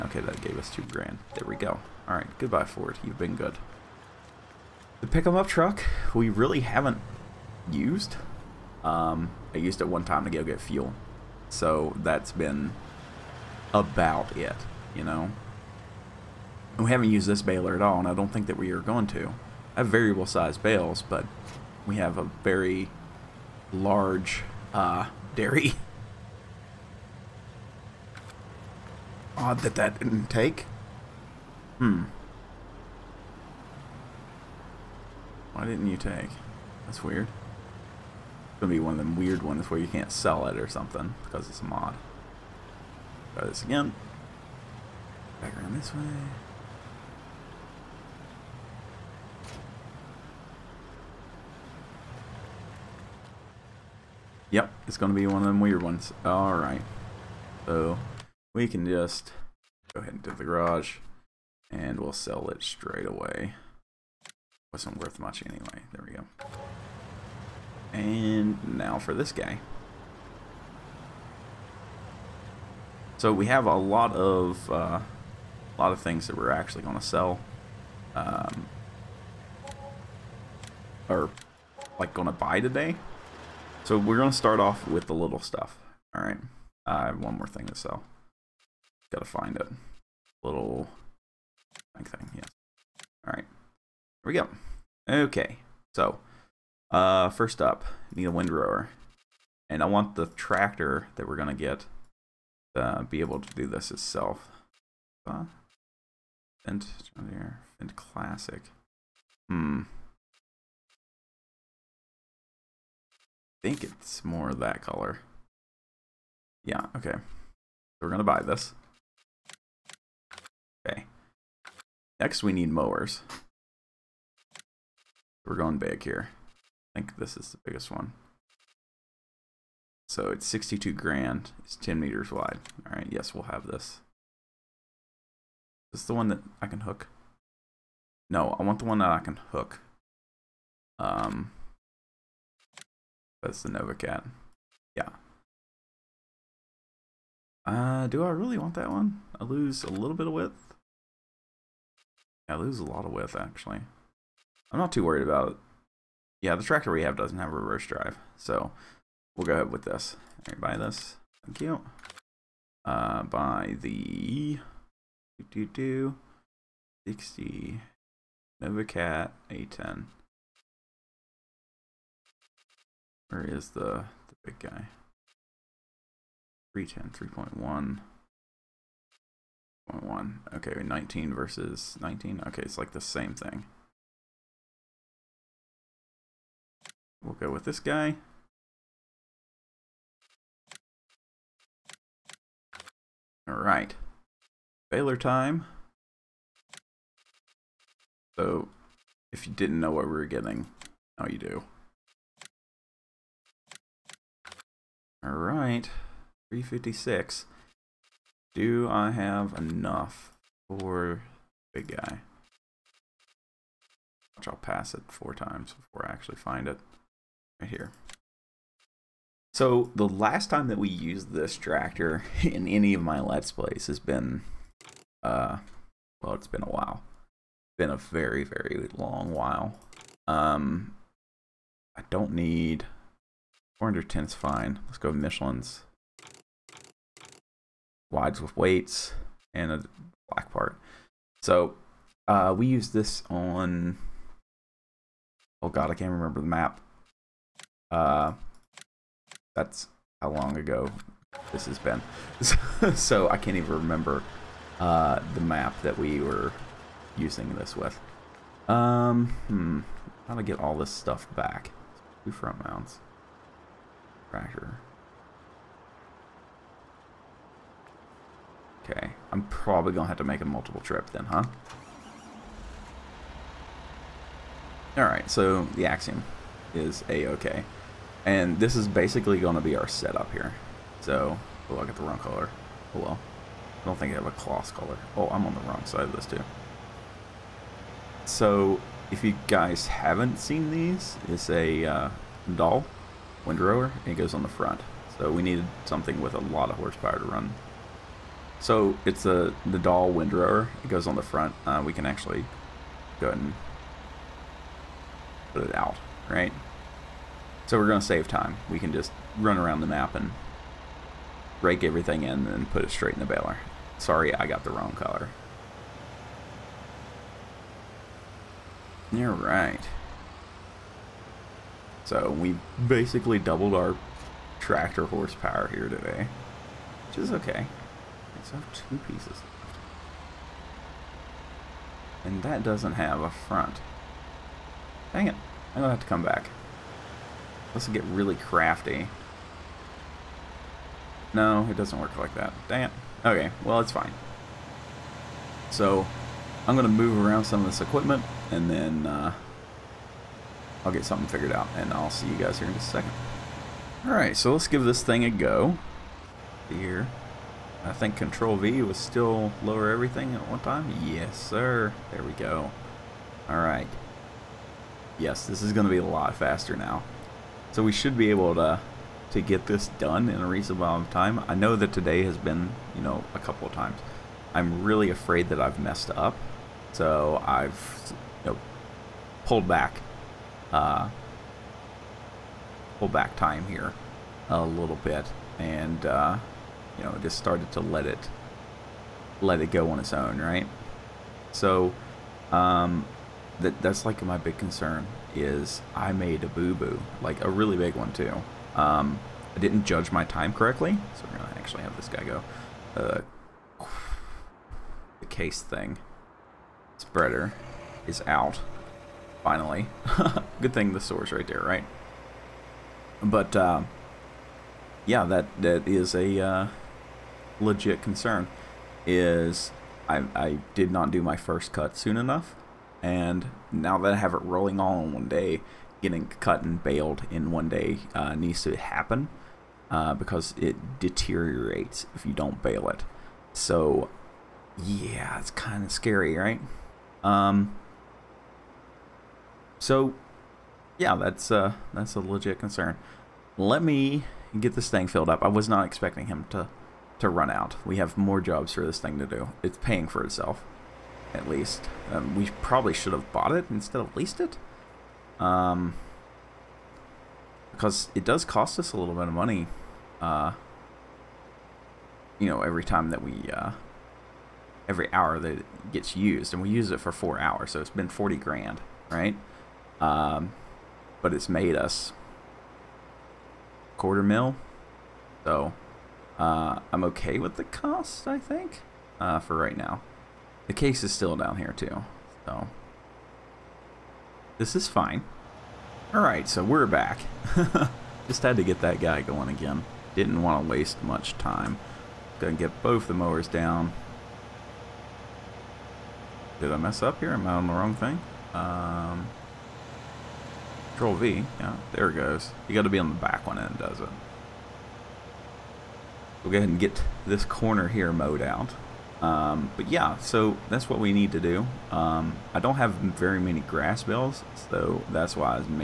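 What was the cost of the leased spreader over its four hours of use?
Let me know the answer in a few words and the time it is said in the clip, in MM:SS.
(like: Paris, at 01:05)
40 grand, at 07:48.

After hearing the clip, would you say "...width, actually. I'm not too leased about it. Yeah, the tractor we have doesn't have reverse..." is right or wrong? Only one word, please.
wrong.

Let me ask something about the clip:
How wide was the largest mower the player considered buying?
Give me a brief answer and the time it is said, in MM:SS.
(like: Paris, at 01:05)
10 meters, at 02:11.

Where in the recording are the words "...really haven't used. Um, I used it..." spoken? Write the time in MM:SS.
00:06.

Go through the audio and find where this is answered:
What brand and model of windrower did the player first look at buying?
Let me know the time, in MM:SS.
01:47.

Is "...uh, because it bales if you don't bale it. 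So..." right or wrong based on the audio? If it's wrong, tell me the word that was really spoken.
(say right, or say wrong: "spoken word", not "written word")
wrong: "deteriorates", not "bales".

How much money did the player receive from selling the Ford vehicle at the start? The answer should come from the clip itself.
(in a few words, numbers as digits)
two grand.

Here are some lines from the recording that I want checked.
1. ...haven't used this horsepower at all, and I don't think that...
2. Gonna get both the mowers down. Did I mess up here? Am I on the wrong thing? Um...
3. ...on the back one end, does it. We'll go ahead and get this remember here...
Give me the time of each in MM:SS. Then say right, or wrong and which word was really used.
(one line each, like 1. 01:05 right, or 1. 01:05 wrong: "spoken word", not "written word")
1. 00:16 wrong: "baler", not "horsepower"
2. 08:12 right
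3. 08:22 wrong: "corner", not "remember".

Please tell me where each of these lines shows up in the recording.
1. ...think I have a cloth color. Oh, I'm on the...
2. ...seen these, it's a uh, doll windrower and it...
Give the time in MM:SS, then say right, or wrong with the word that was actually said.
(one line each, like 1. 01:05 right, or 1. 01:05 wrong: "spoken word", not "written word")
1. 04:43 right
2. 04:50 right.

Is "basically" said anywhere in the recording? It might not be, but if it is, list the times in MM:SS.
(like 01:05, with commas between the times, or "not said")
04:38, 05:22.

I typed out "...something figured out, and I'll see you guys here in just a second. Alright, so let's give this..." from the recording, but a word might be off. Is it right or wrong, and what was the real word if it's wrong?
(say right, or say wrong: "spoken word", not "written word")
right.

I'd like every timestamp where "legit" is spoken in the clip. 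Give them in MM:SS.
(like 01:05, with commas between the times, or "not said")
06:57, 07:22.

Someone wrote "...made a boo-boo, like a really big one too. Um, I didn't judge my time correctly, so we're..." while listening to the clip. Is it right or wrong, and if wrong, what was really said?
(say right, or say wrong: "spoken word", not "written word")
right.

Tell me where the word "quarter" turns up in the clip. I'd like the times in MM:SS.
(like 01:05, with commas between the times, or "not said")
07:53.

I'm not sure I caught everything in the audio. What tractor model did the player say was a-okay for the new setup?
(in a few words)
Axion.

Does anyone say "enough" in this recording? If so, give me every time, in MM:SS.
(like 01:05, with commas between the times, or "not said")
03:29, 07:02.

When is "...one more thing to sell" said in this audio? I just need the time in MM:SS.
01:27.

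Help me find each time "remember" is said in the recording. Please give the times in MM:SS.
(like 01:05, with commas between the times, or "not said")
04:06, 04:13.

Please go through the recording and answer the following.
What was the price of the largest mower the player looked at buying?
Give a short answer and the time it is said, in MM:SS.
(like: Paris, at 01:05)
62 grand, at 02:10.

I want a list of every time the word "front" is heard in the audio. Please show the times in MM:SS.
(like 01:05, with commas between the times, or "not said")
04:22, 04:54, 05:01, 05:33.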